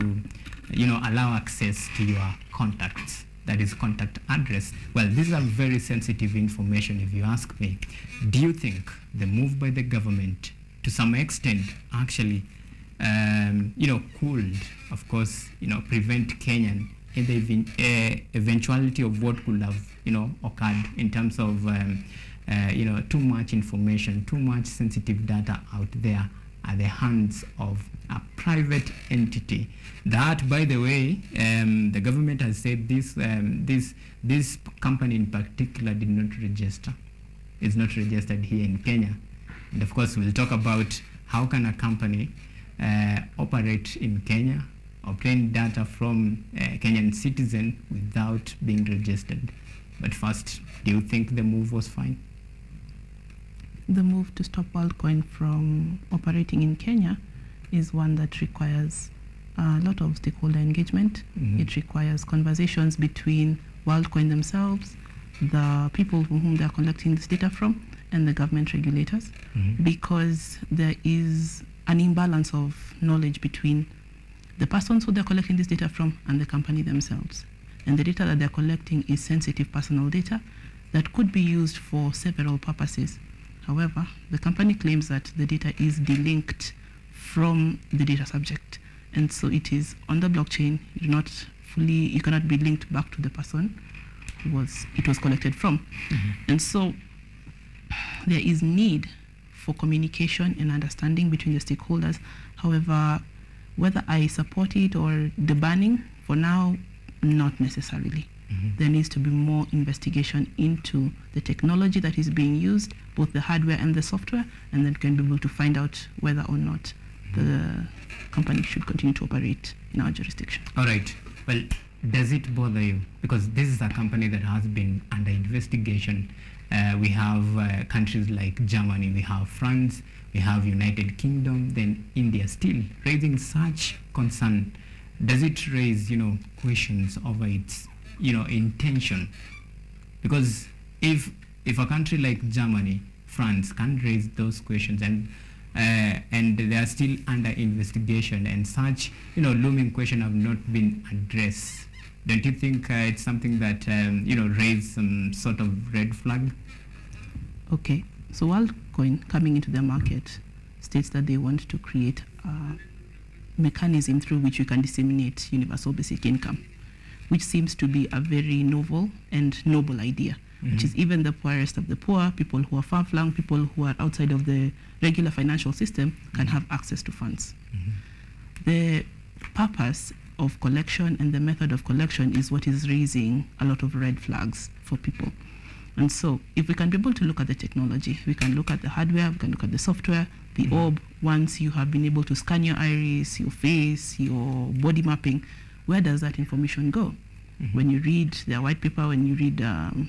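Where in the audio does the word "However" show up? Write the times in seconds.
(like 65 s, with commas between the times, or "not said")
83 s, 102 s.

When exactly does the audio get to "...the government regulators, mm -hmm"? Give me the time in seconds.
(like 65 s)
68 s.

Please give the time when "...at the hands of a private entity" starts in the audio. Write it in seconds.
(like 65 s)
26 s.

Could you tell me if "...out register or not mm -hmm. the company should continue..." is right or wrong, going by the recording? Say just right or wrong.
wrong.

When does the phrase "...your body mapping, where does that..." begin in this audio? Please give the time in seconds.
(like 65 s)
194 s.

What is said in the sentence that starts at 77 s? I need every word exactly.
And the data that they're collecting is sensitive personal data that could be used for several purposes.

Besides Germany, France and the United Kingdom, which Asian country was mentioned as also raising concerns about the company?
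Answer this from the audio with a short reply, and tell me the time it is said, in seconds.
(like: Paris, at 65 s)
India, at 132 s.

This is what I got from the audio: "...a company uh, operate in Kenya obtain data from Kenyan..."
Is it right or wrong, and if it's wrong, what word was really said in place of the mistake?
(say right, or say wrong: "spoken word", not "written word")
right.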